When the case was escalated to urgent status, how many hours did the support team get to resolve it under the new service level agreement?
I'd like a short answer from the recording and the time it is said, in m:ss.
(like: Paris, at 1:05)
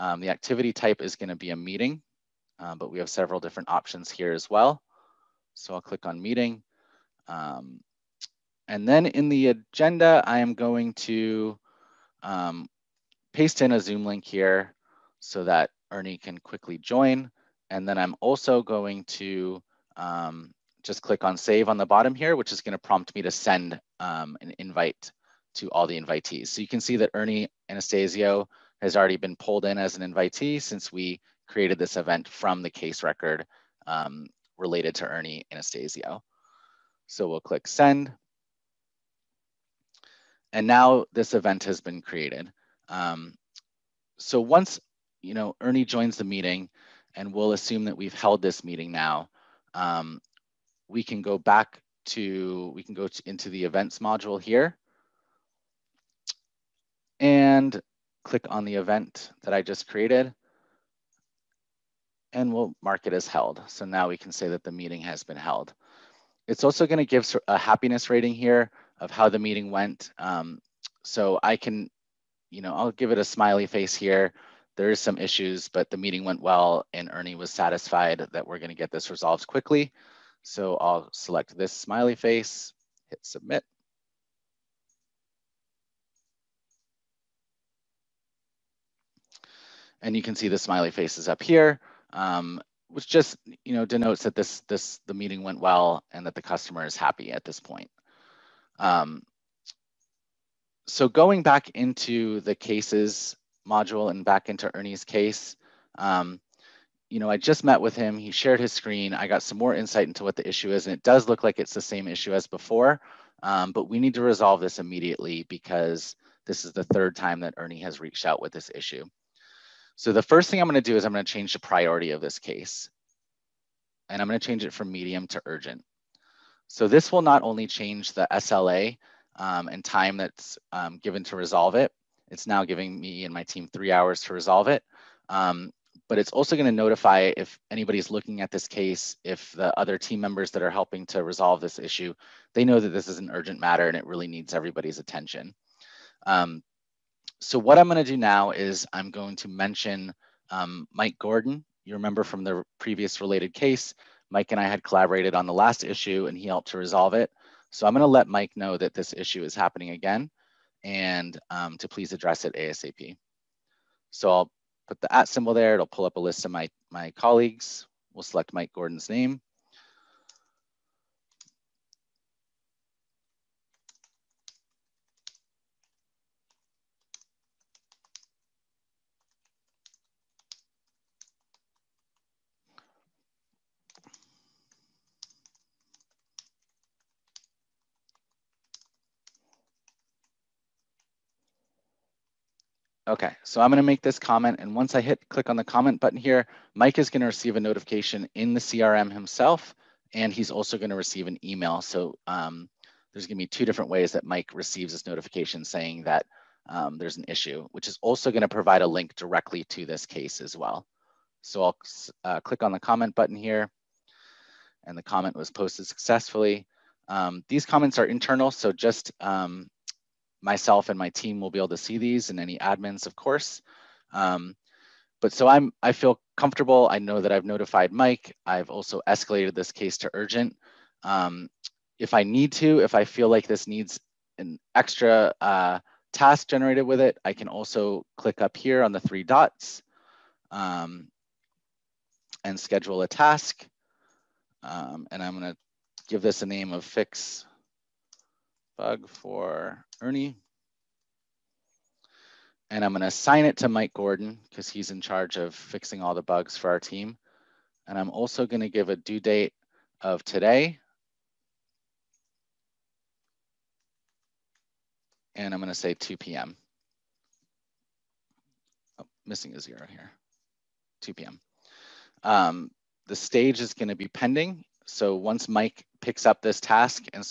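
3, at 2:13.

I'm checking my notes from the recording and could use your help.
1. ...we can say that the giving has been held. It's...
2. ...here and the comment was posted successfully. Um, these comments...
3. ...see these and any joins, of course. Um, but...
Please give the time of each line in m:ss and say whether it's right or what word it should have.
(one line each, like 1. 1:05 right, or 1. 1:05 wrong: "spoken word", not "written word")
1. 1:04 wrong: "meeting", not "giving"
2. 3:33 right
3. 3:41 wrong: "admins", not "joins".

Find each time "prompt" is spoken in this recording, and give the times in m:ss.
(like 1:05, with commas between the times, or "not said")
0:22.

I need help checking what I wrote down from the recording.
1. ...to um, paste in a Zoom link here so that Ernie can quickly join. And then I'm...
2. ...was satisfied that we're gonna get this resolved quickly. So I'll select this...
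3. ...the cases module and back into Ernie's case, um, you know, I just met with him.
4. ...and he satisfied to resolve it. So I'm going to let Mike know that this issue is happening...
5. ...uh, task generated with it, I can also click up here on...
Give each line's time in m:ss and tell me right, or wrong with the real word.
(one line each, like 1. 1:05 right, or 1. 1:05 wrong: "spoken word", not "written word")
1. 0:10 right
2. 1:17 right
3. 1:42 right
4. 2:36 wrong: "helped", not "satisfied"
5. 3:55 right.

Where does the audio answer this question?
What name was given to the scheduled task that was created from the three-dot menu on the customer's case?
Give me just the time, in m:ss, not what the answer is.
4:06.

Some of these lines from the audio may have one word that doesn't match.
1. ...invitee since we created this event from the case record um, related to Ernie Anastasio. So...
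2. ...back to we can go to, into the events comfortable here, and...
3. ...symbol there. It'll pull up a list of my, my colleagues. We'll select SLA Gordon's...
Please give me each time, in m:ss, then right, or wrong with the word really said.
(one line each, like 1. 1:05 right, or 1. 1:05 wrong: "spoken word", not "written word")
1. 0:30 right
2. 0:51 wrong: "module", not "comfortable"
3. 2:45 wrong: "Mike", not "SLA".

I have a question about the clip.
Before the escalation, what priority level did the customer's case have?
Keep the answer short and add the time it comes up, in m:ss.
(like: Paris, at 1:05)
Medium, at 2:04.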